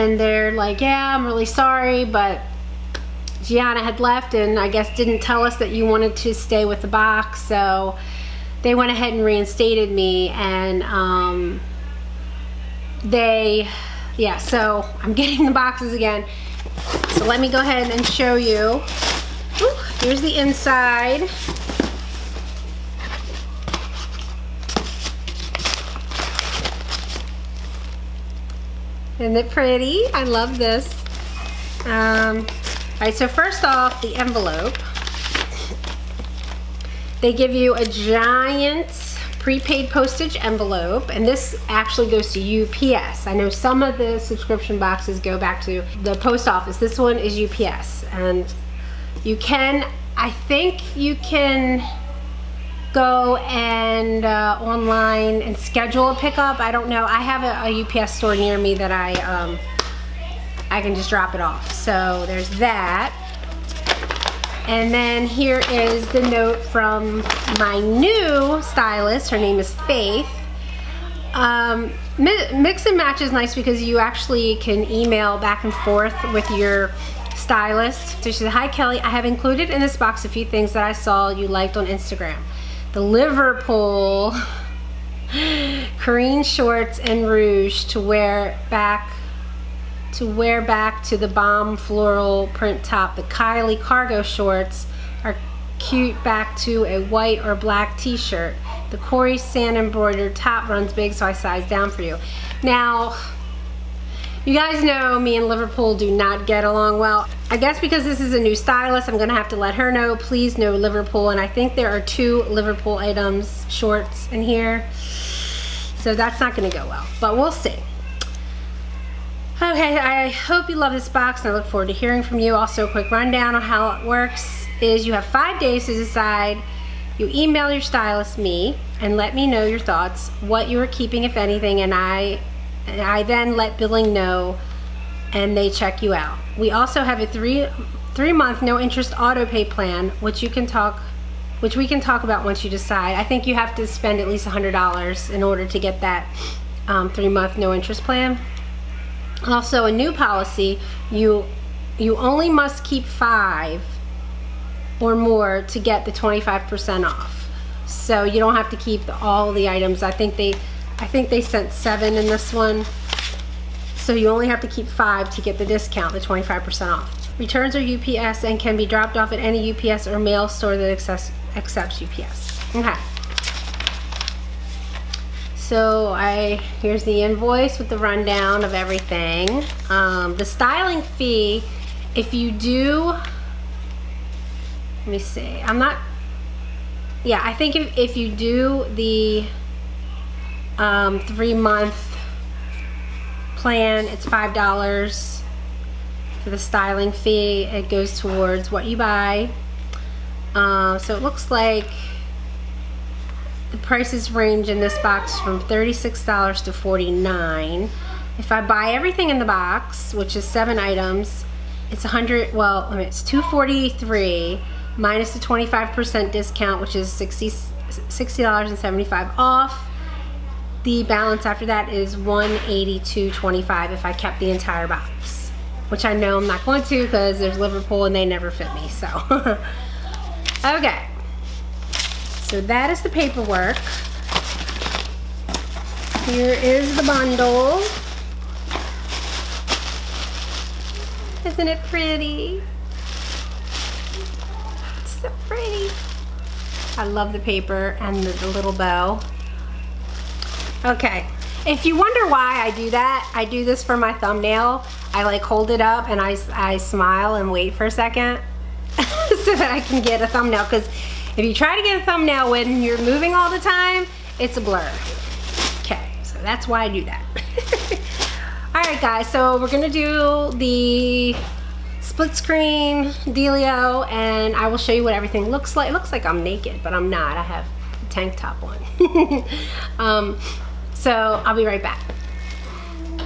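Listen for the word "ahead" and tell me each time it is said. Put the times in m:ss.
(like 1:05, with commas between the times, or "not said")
0:08, 0:17.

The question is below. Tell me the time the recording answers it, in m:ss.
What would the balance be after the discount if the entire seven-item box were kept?
3:42.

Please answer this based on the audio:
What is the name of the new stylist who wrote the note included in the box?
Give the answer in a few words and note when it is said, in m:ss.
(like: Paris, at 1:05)
Faith, at 1:09.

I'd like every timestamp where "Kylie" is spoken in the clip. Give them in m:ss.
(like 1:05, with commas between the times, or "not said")
1:33.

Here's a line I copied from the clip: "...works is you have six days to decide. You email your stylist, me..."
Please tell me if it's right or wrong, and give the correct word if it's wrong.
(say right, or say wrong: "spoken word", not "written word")
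wrong: "five", not "six".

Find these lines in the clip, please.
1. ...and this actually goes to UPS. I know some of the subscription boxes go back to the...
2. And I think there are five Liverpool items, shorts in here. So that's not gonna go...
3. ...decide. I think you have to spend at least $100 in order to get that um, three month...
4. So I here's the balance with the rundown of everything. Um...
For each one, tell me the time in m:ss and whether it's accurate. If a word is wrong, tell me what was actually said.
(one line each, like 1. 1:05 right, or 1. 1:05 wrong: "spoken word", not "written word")
1. 0:41 right
2. 1:51 wrong: "two", not "five"
3. 2:22 right
4. 2:55 wrong: "invoice", not "balance".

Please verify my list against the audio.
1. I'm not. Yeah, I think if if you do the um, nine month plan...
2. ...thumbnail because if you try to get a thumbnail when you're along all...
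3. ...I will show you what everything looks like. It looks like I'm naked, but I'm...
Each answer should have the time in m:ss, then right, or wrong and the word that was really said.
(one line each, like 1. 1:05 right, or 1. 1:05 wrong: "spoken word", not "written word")
1. 3:05 wrong: "three", not "nine"
2. 4:20 wrong: "moving", not "along"
3. 4:34 right.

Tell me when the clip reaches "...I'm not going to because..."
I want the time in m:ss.
3:46.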